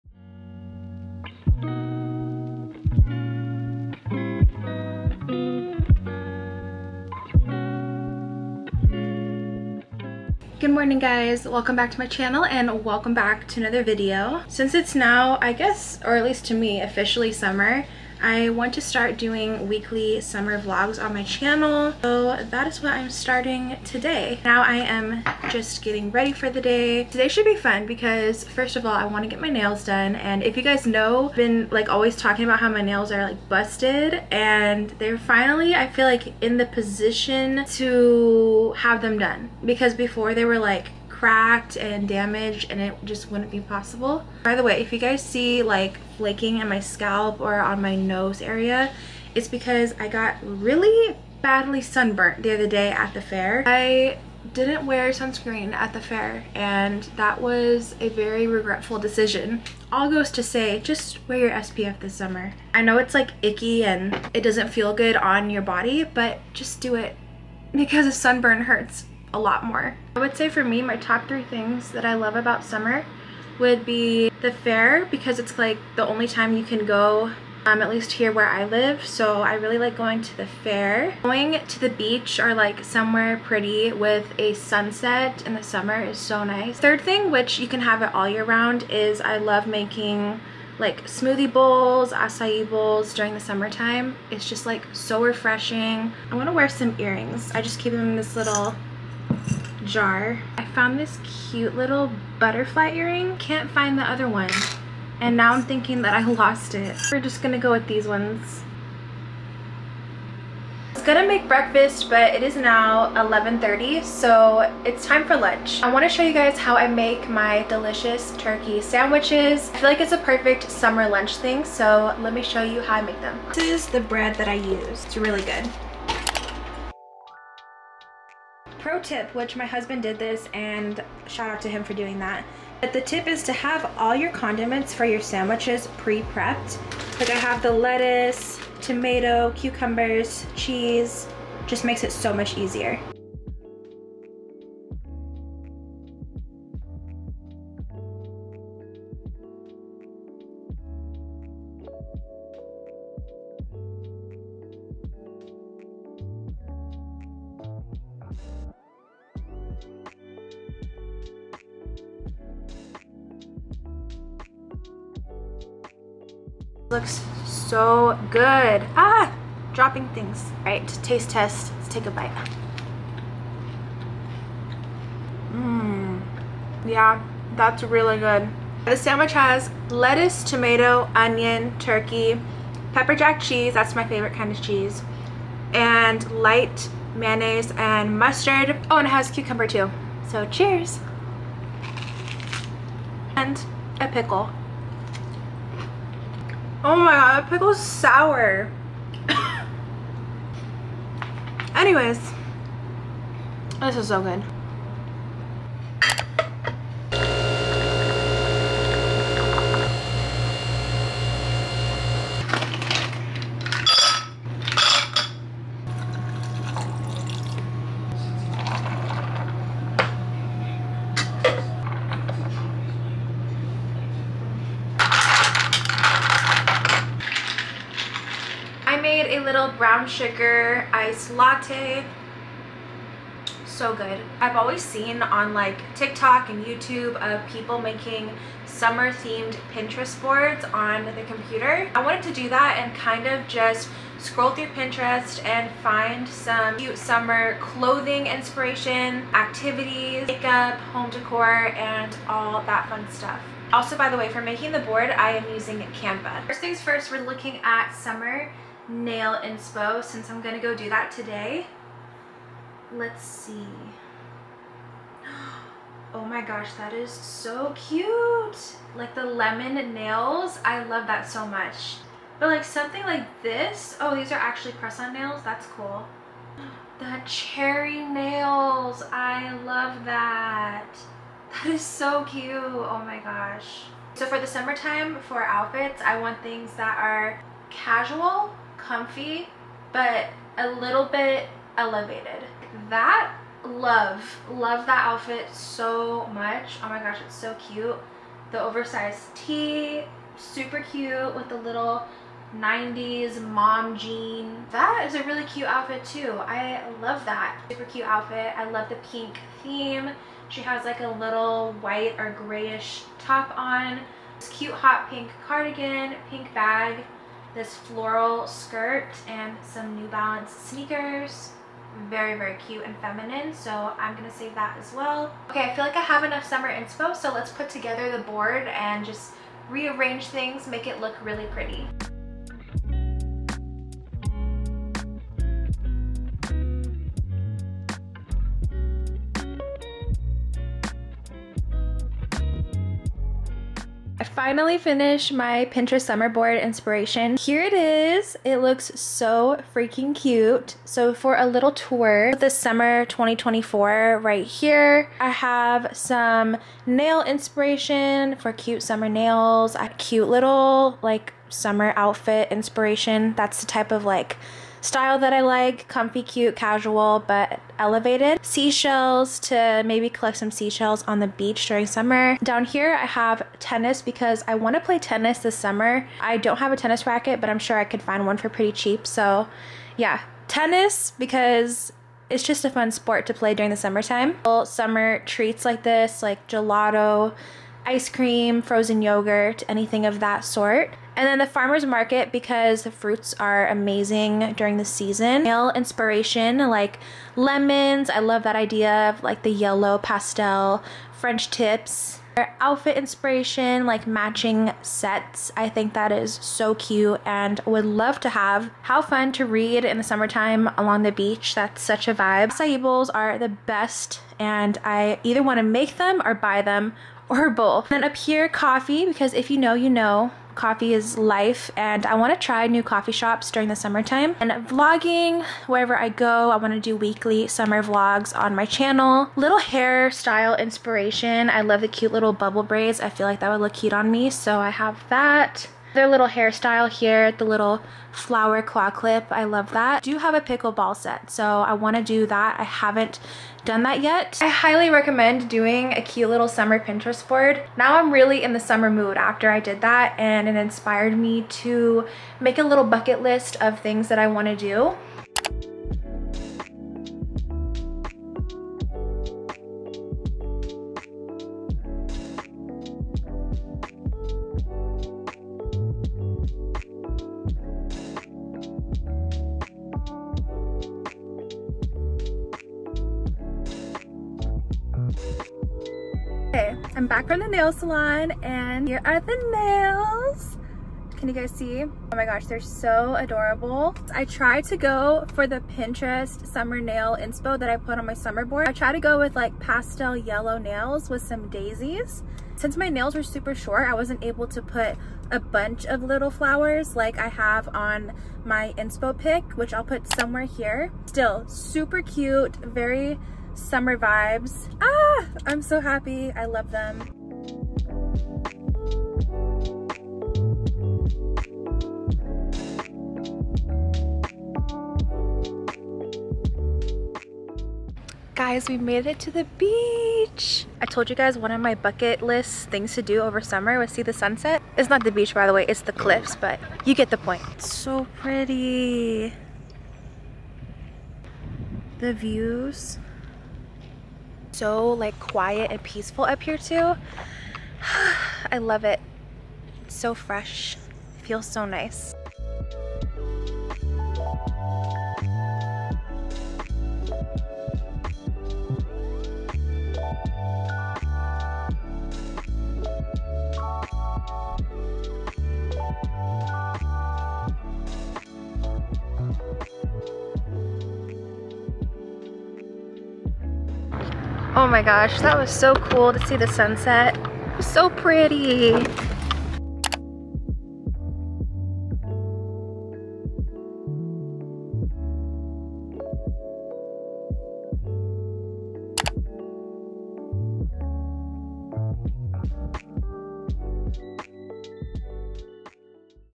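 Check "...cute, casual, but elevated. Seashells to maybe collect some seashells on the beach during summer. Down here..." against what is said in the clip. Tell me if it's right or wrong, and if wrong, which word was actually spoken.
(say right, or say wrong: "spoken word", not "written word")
right.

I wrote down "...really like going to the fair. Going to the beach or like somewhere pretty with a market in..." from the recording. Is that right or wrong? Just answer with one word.
wrong.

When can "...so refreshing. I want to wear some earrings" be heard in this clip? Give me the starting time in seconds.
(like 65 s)
94 s.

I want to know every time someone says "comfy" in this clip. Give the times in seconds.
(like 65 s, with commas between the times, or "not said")
288 s, 365 s.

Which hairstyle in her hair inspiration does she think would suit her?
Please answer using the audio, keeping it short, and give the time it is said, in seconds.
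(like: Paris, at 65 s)
Bubble braids, at 432 s.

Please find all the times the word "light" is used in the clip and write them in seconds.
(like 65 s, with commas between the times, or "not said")
186 s.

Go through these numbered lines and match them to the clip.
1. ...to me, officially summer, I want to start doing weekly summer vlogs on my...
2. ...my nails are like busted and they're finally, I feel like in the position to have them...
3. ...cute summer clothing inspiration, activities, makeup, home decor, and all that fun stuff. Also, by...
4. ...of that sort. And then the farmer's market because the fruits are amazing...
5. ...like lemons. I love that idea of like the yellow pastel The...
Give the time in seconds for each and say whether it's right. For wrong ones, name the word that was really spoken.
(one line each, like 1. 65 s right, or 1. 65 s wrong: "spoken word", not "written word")
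1. 16 s right
2. 32 s right
3. 246 s right
4. 390 s right
5. 396 s wrong: "French", not "The".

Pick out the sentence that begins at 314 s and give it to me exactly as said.
This cute hot pink cardigan, pink bag this floral skirt and some New Balance sneakers.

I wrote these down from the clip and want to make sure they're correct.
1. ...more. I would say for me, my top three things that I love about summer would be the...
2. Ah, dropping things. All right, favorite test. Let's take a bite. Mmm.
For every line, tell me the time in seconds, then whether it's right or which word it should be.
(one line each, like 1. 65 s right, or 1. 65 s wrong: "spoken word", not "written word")
1. 69 s right
2. 168 s wrong: "taste", not "favorite".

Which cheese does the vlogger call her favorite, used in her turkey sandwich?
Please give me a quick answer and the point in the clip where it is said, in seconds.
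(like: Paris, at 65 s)
Pepper jack, at 182 s.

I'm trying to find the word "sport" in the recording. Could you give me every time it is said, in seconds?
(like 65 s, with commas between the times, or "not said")
382 s.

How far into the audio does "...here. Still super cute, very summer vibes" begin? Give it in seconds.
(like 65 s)
500 s.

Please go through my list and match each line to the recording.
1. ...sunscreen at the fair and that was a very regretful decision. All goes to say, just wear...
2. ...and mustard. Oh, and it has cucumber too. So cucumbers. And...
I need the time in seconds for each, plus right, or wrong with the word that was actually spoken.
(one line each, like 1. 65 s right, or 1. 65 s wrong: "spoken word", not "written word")
1. 55 s right
2. 187 s wrong: "cheers", not "cucumbers".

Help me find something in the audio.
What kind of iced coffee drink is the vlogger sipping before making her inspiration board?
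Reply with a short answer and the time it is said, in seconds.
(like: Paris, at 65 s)
Brown sugar iced latte, at 229 s.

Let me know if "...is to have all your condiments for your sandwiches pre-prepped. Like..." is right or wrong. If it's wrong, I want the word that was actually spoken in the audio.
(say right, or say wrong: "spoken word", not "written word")
right.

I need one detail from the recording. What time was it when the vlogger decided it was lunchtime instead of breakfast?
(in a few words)
11:30.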